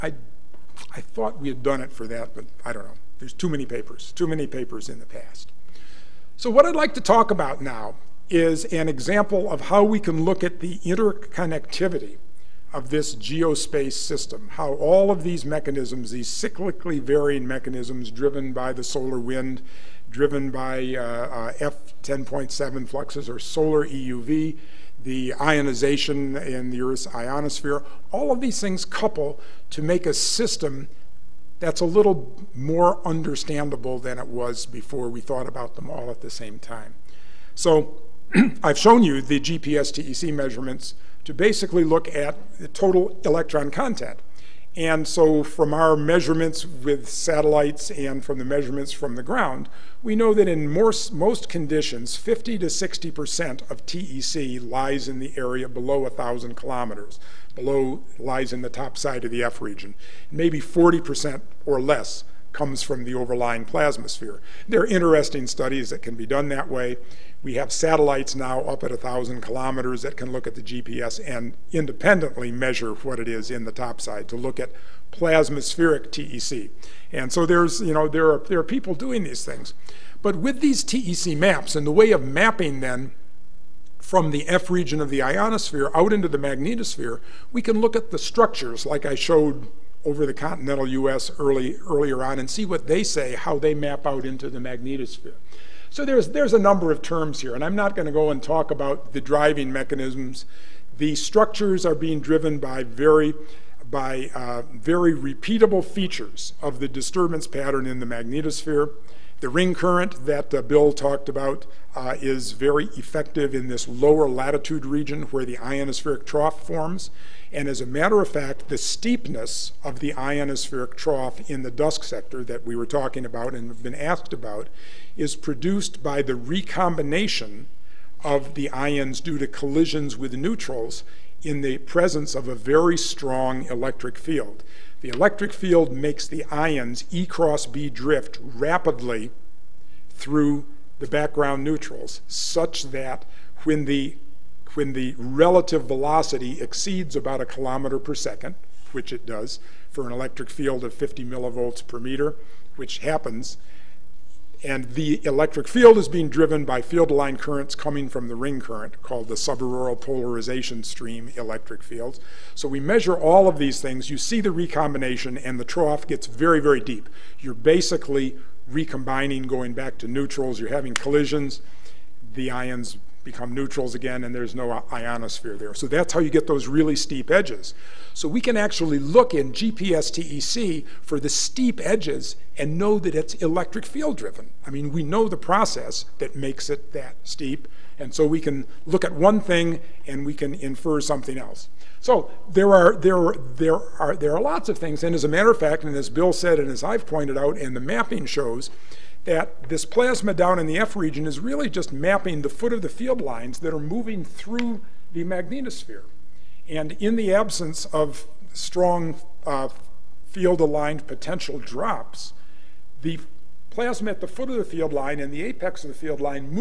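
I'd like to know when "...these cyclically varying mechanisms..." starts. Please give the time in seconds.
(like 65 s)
16 s.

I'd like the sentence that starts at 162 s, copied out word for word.
So we measure all of these things.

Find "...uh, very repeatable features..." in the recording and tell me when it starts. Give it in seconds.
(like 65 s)
104 s.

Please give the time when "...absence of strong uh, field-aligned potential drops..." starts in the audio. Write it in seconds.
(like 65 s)
207 s.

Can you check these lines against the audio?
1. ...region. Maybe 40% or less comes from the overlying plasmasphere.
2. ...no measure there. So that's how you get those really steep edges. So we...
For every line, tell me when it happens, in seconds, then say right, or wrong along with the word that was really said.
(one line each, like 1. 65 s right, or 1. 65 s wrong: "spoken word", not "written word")
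1. 59 s right
2. 174 s wrong: "ionosphere", not "measure".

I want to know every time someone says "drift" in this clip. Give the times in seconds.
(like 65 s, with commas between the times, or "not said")
137 s.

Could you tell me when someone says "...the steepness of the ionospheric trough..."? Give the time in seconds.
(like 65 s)
118 s.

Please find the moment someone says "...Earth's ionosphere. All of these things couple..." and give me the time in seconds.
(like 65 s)
26 s.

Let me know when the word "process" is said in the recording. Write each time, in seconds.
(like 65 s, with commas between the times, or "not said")
185 s.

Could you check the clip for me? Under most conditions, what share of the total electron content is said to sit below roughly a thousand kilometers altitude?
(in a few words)
50 to 60%.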